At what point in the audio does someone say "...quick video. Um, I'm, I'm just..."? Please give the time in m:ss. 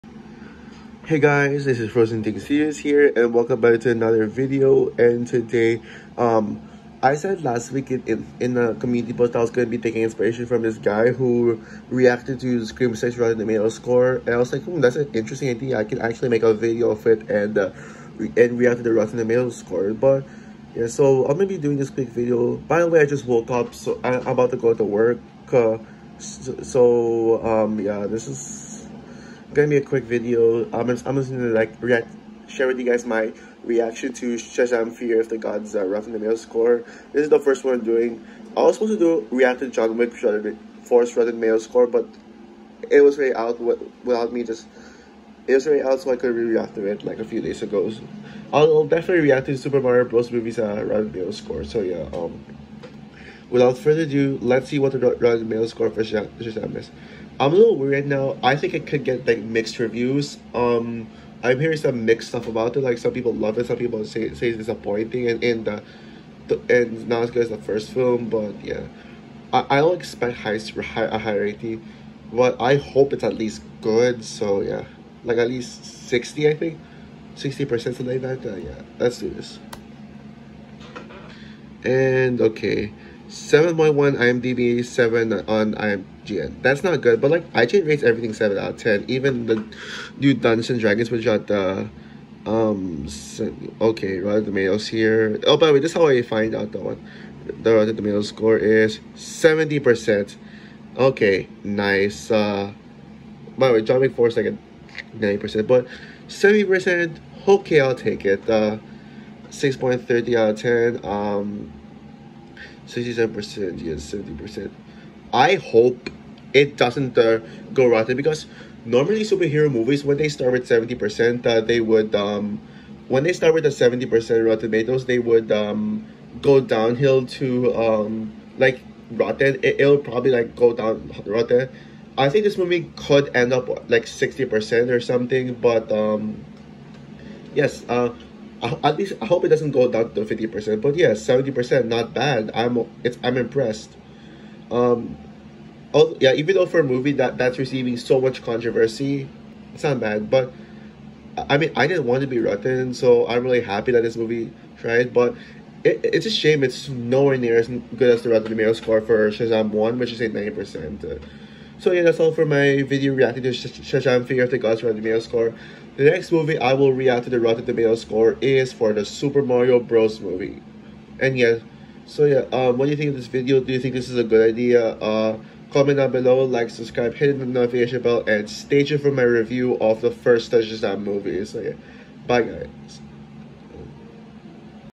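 0:29.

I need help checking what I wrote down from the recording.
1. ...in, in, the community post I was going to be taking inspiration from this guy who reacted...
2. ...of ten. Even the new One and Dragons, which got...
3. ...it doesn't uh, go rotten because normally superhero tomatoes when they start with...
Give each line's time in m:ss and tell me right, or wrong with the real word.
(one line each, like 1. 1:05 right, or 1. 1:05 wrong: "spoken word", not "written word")
1. 0:07 right
2. 1:28 wrong: "Dungeons", not "One"
3. 1:56 wrong: "movies", not "tomatoes".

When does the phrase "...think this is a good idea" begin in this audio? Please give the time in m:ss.
2:53.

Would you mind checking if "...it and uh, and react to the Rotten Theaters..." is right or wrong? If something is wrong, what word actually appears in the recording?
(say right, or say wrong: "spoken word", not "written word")
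wrong: "Tomato", not "Theaters".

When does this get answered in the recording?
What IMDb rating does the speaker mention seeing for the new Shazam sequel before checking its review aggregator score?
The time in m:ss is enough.
1:23.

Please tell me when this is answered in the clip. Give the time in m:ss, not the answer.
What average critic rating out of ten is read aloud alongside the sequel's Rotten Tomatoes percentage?
1:49.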